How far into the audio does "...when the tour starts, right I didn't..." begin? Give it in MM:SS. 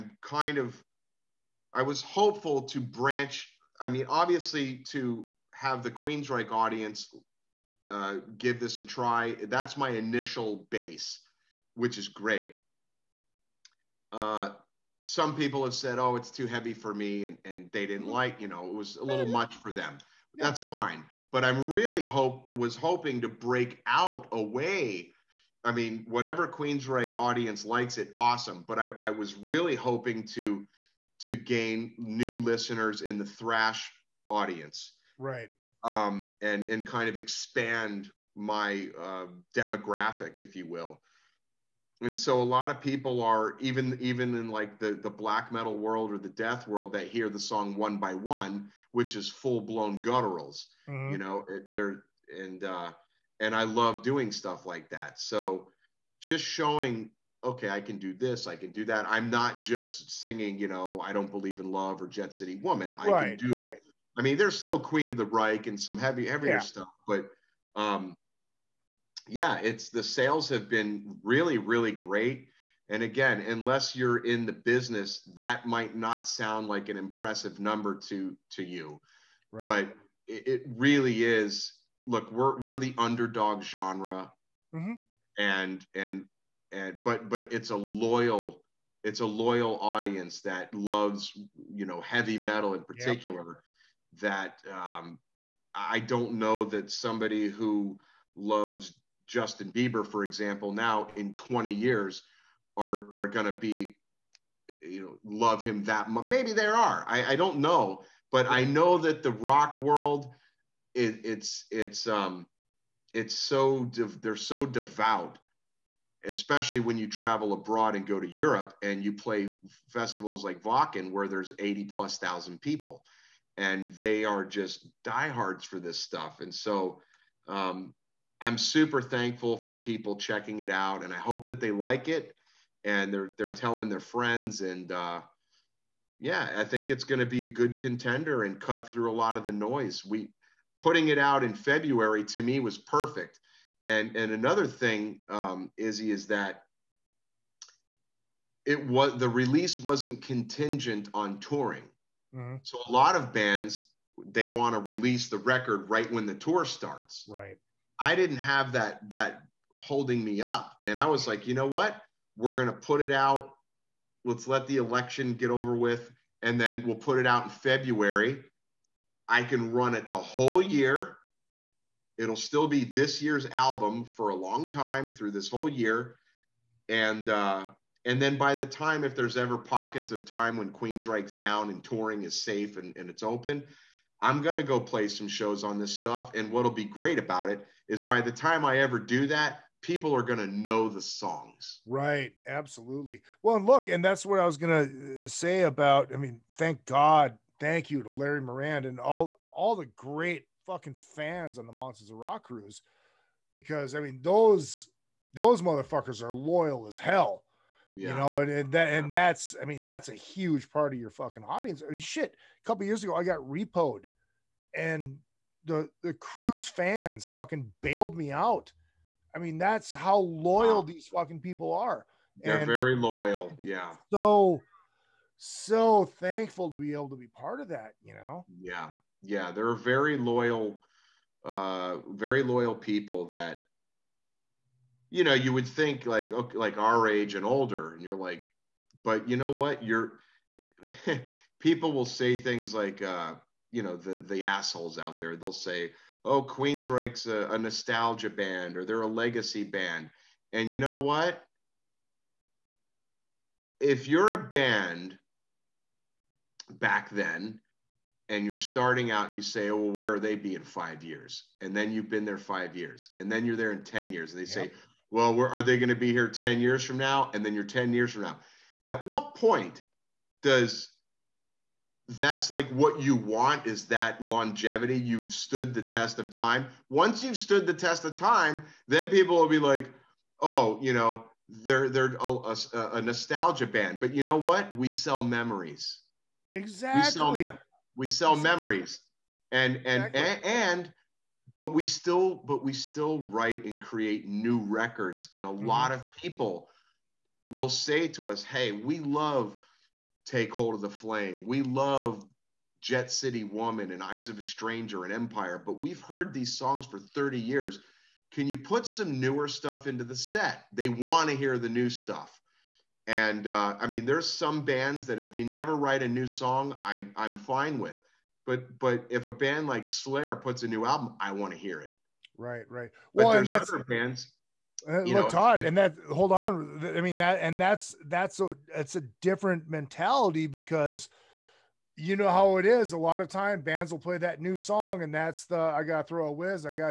02:36.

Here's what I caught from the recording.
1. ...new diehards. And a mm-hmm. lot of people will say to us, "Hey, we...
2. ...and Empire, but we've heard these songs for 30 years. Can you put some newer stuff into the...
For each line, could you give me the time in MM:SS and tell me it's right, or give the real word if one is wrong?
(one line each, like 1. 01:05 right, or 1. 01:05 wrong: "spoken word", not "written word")
1. 04:54 wrong: "records", not "diehards"
2. 05:05 right.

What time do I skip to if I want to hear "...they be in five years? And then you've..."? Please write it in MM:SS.
04:20.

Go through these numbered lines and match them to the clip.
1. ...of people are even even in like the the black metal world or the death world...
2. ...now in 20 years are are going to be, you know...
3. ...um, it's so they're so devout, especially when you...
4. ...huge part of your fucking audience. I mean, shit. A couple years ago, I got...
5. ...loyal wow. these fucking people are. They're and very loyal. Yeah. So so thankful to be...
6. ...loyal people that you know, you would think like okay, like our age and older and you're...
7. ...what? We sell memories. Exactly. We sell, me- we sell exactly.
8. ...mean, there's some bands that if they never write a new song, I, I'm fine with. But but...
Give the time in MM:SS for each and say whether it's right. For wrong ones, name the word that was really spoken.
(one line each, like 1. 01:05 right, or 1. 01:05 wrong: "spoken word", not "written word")
1. 00:42 right
2. 01:40 right
3. 01:52 right
4. 03:30 right
5. 03:40 right
6. 03:52 right
7. 04:44 right
8. 05:13 right.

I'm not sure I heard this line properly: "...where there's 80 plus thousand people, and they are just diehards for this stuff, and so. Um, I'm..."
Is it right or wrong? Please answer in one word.
right.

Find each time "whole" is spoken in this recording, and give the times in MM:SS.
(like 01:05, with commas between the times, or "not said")
02:50, 02:55.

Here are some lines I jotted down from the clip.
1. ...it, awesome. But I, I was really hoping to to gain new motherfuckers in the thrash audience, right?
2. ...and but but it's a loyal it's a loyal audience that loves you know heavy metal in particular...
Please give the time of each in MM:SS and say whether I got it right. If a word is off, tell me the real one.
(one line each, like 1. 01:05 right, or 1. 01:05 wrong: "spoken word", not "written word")
1. 00:27 wrong: "listeners", not "motherfuckers"
2. 01:26 right.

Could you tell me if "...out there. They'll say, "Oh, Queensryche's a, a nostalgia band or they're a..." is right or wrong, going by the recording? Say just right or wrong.
right.